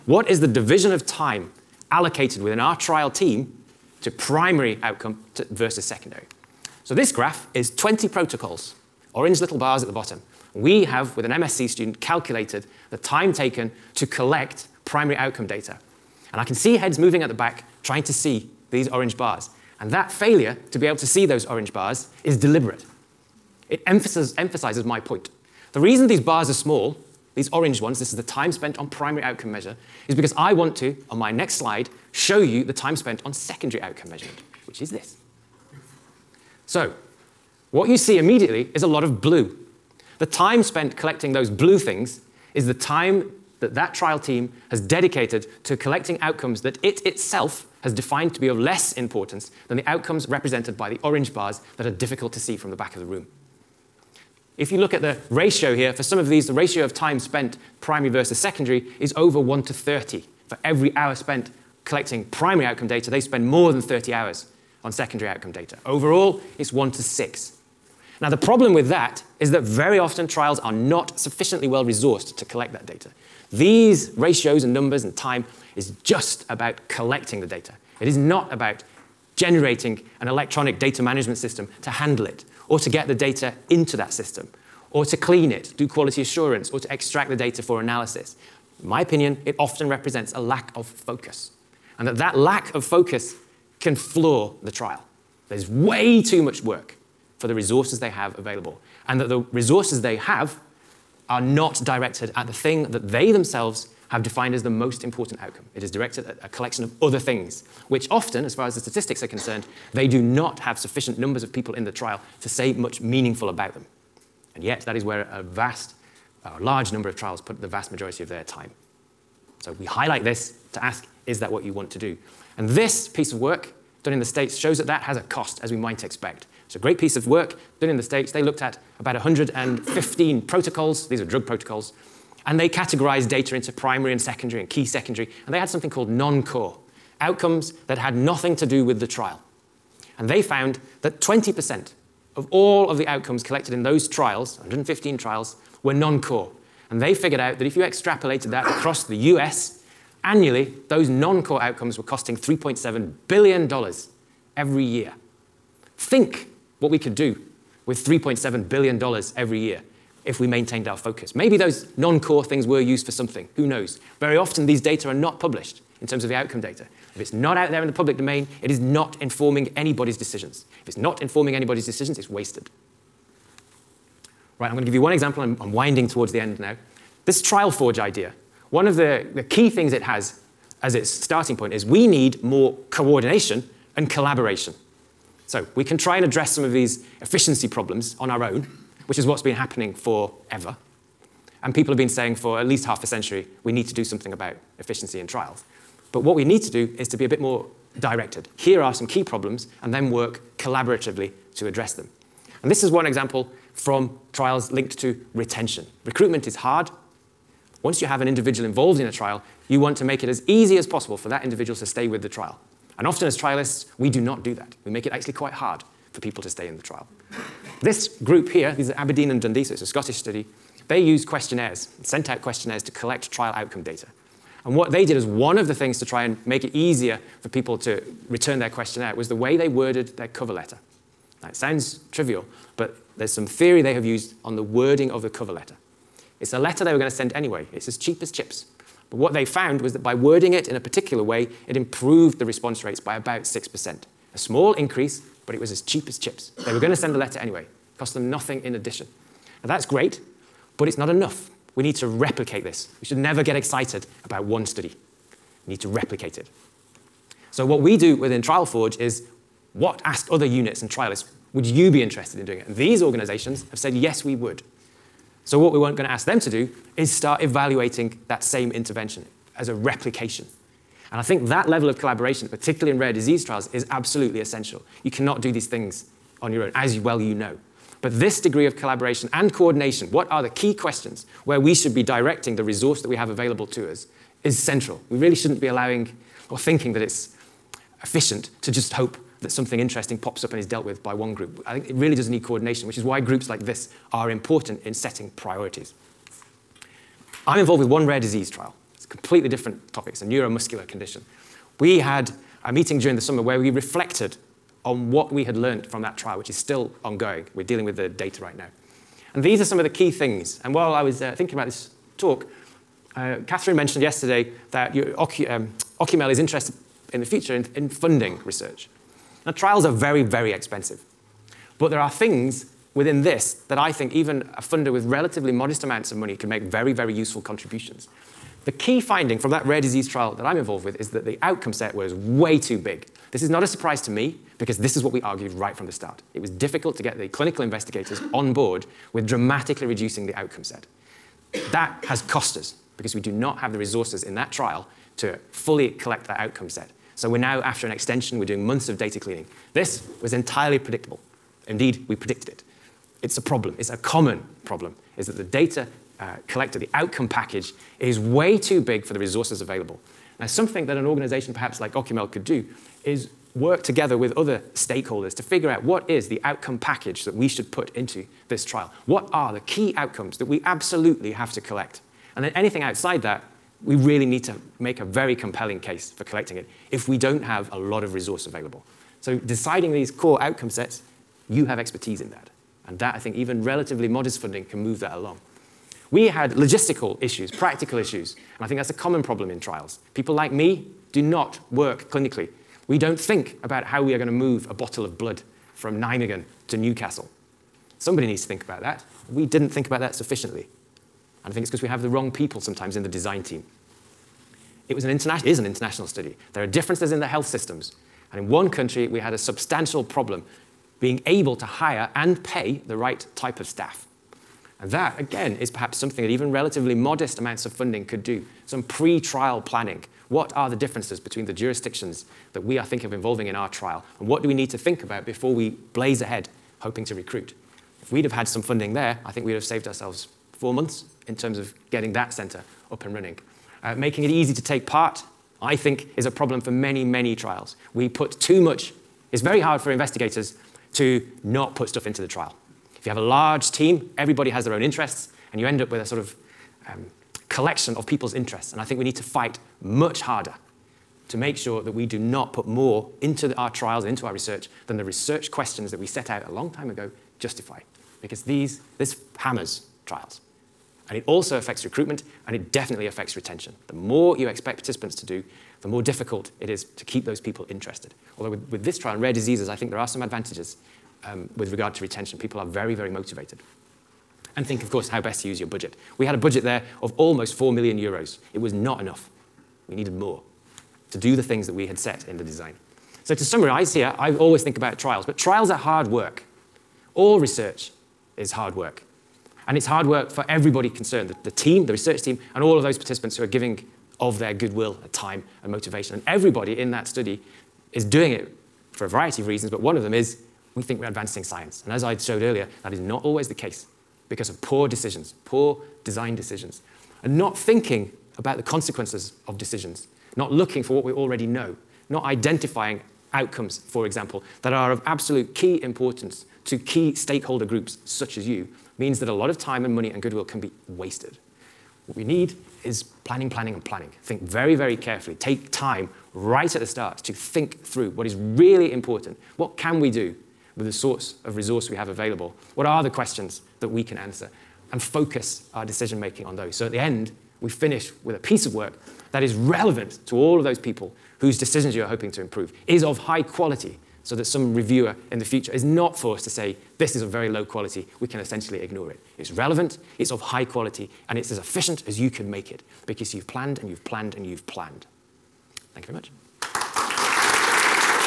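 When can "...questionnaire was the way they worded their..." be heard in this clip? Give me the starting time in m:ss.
3:48.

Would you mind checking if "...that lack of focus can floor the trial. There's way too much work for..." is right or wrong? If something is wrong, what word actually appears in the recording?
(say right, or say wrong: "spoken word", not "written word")
right.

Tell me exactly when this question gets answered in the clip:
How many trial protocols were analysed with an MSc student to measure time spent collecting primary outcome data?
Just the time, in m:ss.
0:07.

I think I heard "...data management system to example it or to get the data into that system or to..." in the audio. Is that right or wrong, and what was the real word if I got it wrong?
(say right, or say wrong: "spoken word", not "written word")
wrong: "handle", not "example".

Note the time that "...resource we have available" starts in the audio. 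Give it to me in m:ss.
8:51.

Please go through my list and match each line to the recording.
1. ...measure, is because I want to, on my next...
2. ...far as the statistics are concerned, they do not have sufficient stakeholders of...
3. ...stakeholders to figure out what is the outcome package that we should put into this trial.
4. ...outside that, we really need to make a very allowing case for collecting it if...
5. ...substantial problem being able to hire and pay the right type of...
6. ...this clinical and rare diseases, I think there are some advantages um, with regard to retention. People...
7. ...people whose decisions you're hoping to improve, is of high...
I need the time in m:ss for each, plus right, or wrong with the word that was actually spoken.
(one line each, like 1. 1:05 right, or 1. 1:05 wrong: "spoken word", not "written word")
1. 0:29 right
2. 1:48 wrong: "numbers", not "stakeholders"
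3. 6:04 right
4. 6:12 wrong: "compelling", not "allowing"
5. 6:49 right
6. 7:48 wrong: "trial", not "clinical"
7. 9:00 right.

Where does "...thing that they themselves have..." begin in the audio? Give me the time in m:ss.
1:42.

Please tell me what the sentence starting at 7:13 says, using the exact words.
Uh, making it easy to take part, I think, is a problem for many, many trials.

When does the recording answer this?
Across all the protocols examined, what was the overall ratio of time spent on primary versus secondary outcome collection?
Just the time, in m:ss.
1:06.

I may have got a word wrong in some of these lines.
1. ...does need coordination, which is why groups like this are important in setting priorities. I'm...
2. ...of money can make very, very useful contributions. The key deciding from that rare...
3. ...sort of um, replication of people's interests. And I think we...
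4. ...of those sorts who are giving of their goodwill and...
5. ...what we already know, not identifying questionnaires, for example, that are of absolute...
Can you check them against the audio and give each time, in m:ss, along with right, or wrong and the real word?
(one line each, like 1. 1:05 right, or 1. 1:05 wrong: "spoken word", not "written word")
1. 4:52 right
2. 5:26 wrong: "finding", not "deciding"
3. 7:26 wrong: "collection", not "replication"
4. 8:12 wrong: "participants", not "sorts"
5. 8:30 wrong: "outcomes", not "questionnaires".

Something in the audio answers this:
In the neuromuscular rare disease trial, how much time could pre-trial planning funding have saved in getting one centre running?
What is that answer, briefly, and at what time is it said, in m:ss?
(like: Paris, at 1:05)
4 months, at 7:10.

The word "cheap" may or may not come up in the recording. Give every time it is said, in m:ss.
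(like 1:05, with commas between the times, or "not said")
3:57, 4:05.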